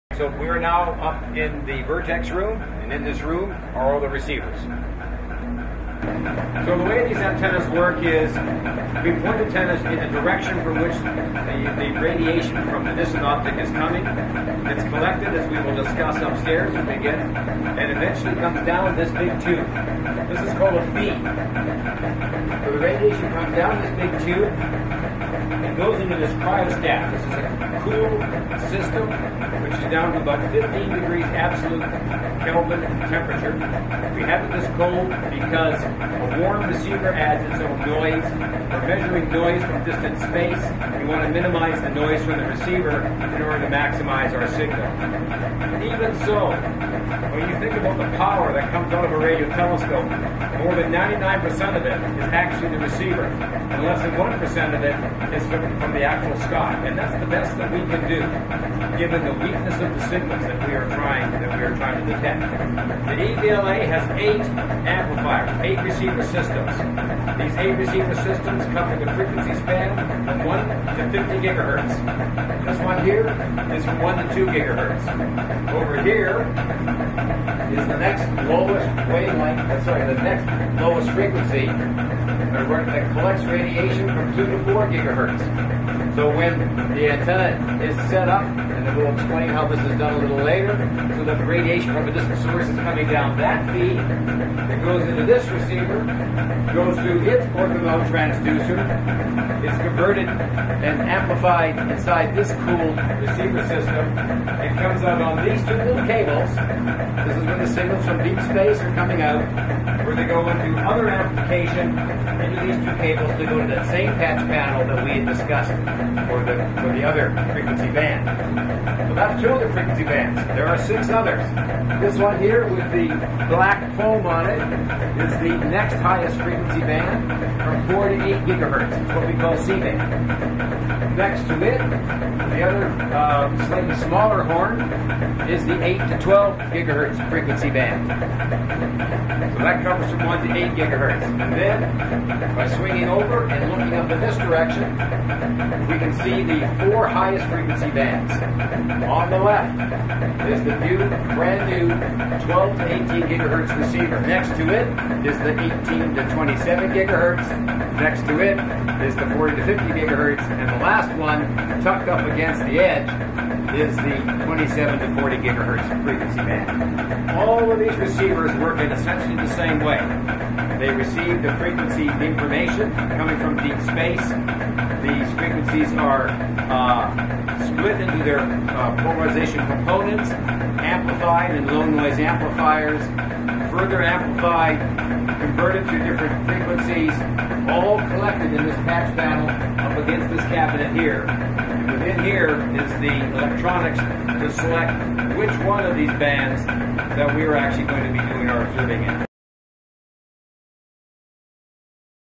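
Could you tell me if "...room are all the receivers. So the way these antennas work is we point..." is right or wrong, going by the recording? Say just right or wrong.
right.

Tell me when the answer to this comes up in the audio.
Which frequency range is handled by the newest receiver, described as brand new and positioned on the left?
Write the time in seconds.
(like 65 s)
152 s.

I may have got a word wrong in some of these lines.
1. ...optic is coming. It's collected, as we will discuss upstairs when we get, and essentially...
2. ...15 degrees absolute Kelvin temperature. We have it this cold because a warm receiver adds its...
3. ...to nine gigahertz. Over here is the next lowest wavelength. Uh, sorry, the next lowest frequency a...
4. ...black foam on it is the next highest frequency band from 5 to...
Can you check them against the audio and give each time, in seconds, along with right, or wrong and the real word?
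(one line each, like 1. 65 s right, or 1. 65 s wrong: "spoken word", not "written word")
1. 13 s wrong: "eventually", not "essentially"
2. 30 s right
3. 74 s wrong: "two", not "nine"
4. 123 s wrong: "4", not "5".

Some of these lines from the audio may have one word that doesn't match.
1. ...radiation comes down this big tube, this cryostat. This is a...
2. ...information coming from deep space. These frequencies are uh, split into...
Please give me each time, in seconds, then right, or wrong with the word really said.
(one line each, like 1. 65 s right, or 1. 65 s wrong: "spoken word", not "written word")
1. 22 s right
2. 172 s right.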